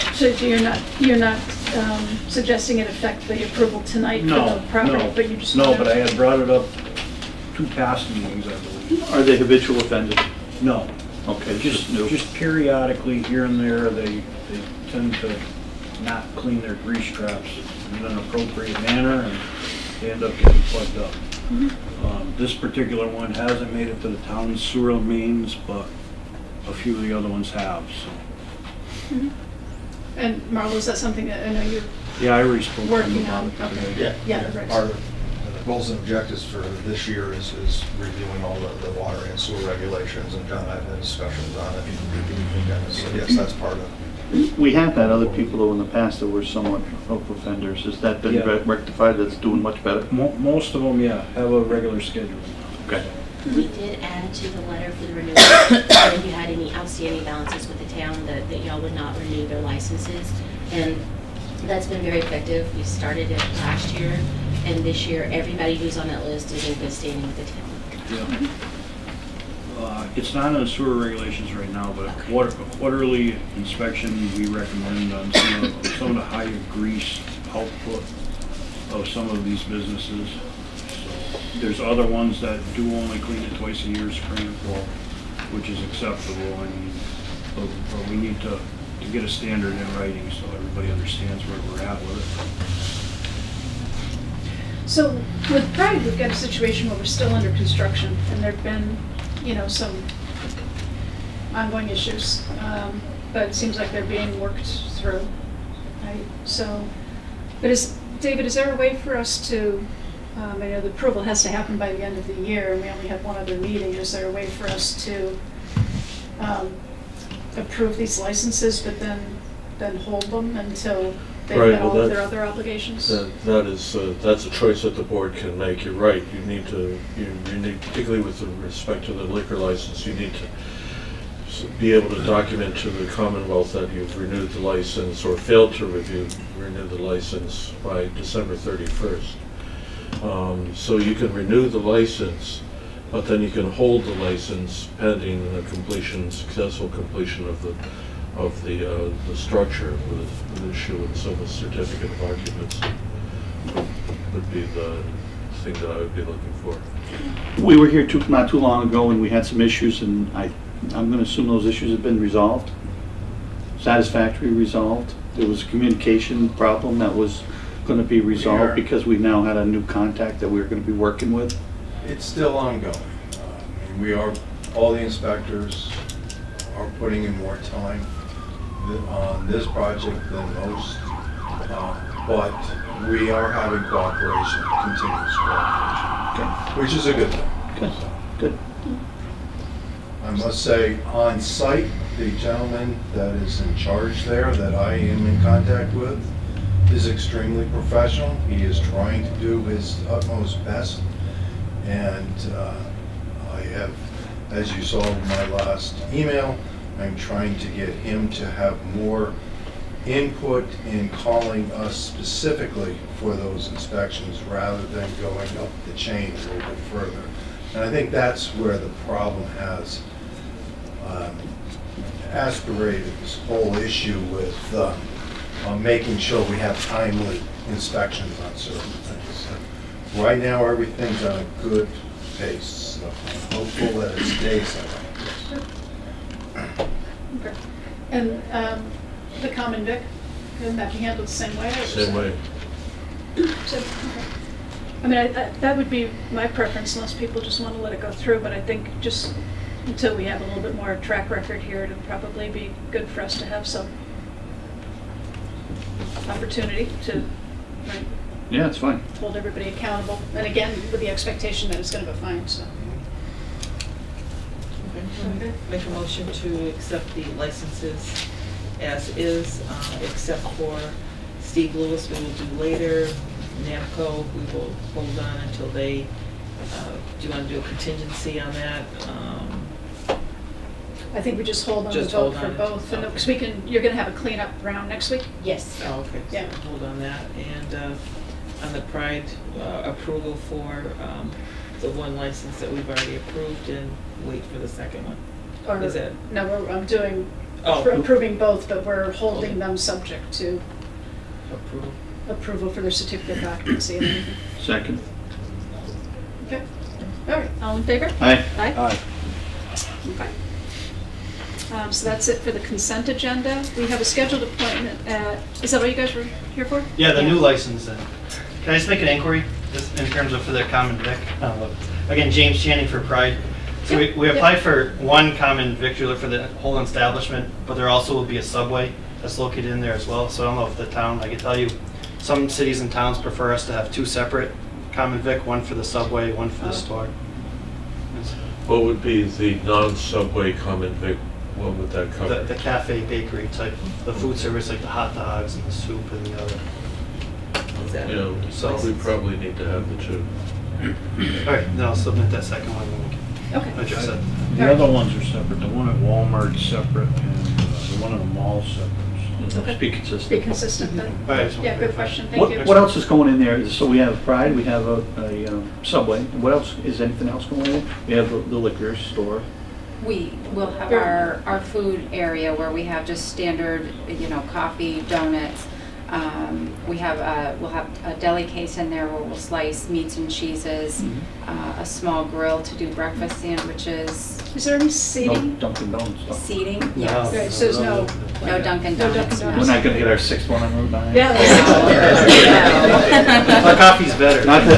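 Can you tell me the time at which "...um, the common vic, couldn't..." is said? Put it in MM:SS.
03:58.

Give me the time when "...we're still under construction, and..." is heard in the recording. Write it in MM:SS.
01:36.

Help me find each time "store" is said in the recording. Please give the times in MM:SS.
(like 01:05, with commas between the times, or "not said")
05:36, 06:08.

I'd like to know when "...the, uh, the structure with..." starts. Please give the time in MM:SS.
02:28.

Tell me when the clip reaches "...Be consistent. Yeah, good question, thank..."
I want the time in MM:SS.
06:00.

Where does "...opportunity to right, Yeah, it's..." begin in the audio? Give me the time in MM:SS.
04:16.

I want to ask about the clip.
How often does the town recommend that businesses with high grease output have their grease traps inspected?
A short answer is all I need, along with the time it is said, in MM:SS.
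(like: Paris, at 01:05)
Quarterly, at 01:12.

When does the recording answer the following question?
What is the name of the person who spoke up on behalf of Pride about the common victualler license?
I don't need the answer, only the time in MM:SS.
05:22.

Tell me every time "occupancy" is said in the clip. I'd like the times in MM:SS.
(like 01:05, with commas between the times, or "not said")
02:32, 05:03.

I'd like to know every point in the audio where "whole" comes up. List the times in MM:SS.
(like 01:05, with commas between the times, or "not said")
03:43, 05:26.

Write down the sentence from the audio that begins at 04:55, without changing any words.
Or, Is it- No, we're, I'm doing, Oh.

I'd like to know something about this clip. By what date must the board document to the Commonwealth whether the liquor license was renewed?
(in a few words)
December 31.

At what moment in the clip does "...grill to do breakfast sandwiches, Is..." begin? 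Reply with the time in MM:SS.
06:22.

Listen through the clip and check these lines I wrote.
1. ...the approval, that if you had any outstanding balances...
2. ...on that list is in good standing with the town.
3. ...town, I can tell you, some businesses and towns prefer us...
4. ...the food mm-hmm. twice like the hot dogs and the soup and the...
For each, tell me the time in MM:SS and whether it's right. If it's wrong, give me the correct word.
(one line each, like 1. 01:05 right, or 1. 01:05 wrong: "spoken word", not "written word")
1. 00:55 wrong: "renewal", not "approval"
2. 01:05 right
3. 05:30 wrong: "cities", not "businesses"
4. 05:44 wrong: "service", not "twice".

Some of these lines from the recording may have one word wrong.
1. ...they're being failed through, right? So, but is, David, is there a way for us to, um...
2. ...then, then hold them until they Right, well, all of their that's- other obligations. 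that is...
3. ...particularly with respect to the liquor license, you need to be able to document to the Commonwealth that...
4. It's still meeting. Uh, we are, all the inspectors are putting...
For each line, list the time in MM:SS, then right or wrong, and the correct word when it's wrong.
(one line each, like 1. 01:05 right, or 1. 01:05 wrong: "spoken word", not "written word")
1. 01:43 wrong: "worked", not "failed"
2. 01:58 right
3. 02:07 right
4. 02:52 wrong: "ongoing", not "meeting".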